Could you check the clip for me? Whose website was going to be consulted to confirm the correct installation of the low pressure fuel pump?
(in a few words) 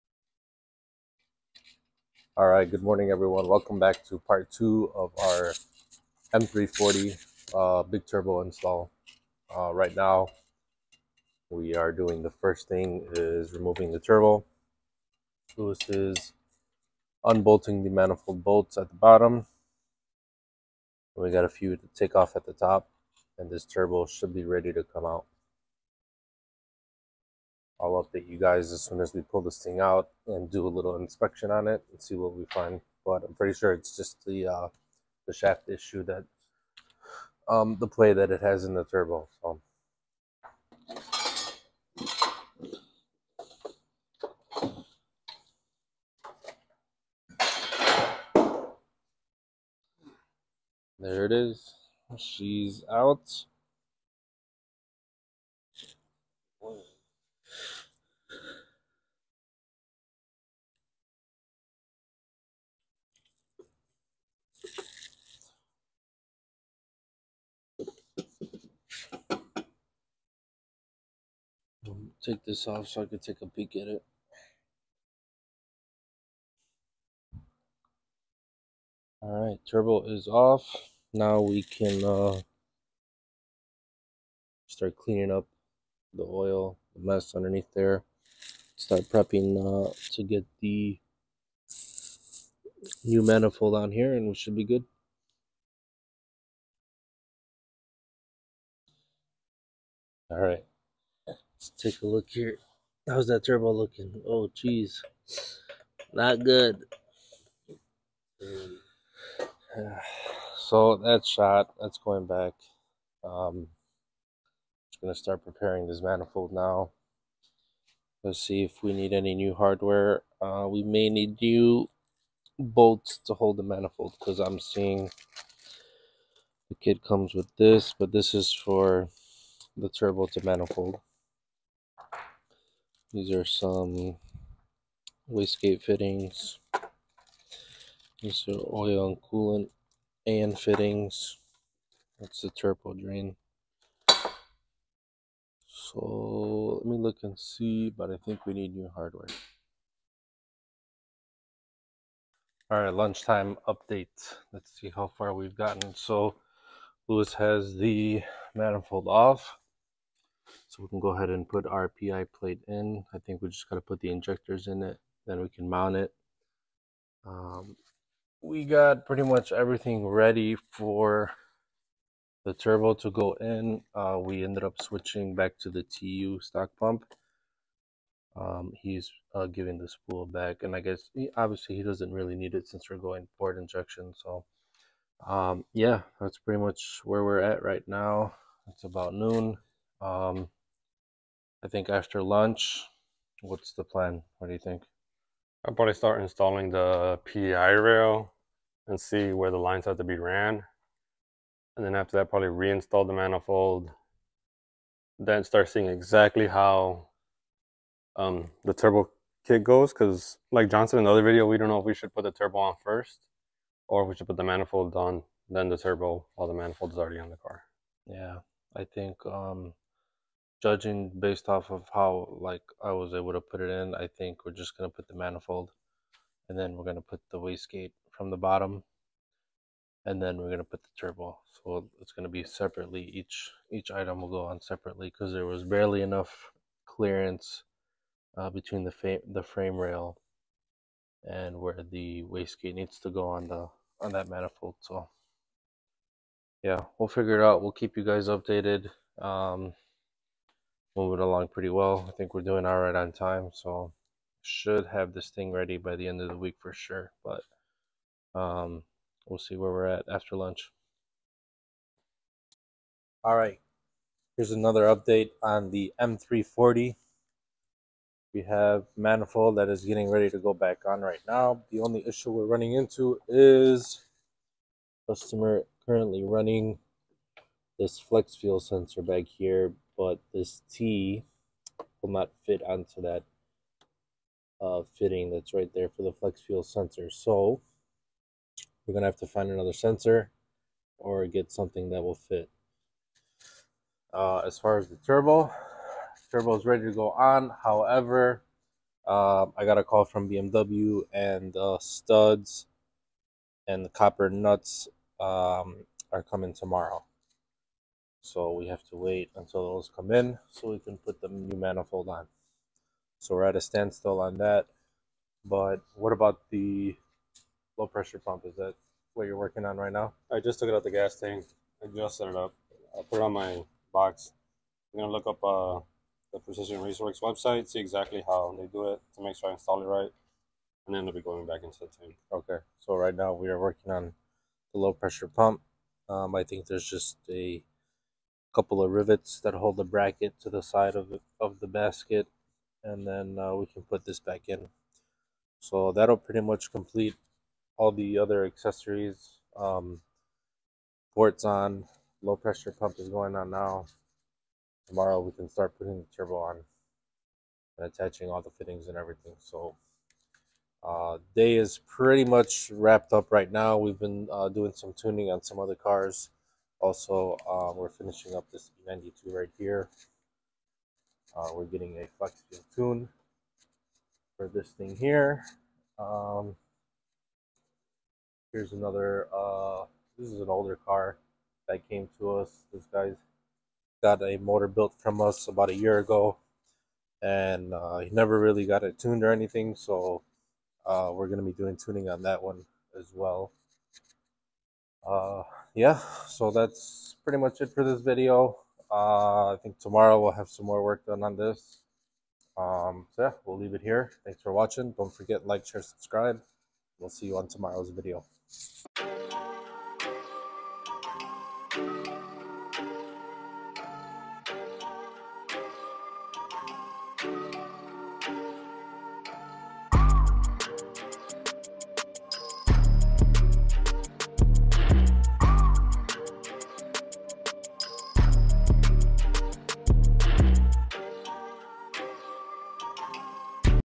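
Precision Raceworks.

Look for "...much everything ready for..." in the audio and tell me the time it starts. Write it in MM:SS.
02:49.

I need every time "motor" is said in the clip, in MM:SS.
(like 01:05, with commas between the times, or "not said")
06:24.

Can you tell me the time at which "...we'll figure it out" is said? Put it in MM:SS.
04:06.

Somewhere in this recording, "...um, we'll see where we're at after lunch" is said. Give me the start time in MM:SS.
04:18.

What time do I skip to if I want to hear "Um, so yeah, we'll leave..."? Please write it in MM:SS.
06:42.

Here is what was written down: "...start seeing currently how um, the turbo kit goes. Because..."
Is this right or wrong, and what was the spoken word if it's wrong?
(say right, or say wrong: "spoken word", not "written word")
wrong: "exactly", not "currently".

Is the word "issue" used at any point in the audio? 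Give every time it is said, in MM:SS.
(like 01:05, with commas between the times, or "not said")
00:35, 04:32.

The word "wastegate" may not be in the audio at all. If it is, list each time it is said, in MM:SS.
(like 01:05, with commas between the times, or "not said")
02:15, 03:47, 04:02.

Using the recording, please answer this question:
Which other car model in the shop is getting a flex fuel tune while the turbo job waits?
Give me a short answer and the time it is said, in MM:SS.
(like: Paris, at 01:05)
E92, at 06:08.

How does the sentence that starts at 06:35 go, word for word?
Uh, yeah, so that's pretty much it for this video.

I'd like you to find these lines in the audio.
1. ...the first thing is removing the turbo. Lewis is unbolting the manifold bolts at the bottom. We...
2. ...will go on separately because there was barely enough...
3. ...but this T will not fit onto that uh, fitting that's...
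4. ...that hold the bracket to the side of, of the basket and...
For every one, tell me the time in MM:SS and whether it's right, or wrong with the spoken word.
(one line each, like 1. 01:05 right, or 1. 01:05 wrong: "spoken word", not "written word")
1. 00:12 right
2. 03:54 right
3. 04:40 right
4. 05:39 right.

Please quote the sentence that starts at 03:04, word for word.
So, um, yeah, that's pretty much where we're at right now.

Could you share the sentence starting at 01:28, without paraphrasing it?
Start prepping uh, to get the new manifold on here and we should be good.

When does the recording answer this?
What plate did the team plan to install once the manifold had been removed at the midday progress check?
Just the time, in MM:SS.
02:41.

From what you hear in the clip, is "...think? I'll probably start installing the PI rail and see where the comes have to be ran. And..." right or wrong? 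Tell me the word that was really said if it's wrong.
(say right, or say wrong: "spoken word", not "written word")
wrong: "lines", not "comes".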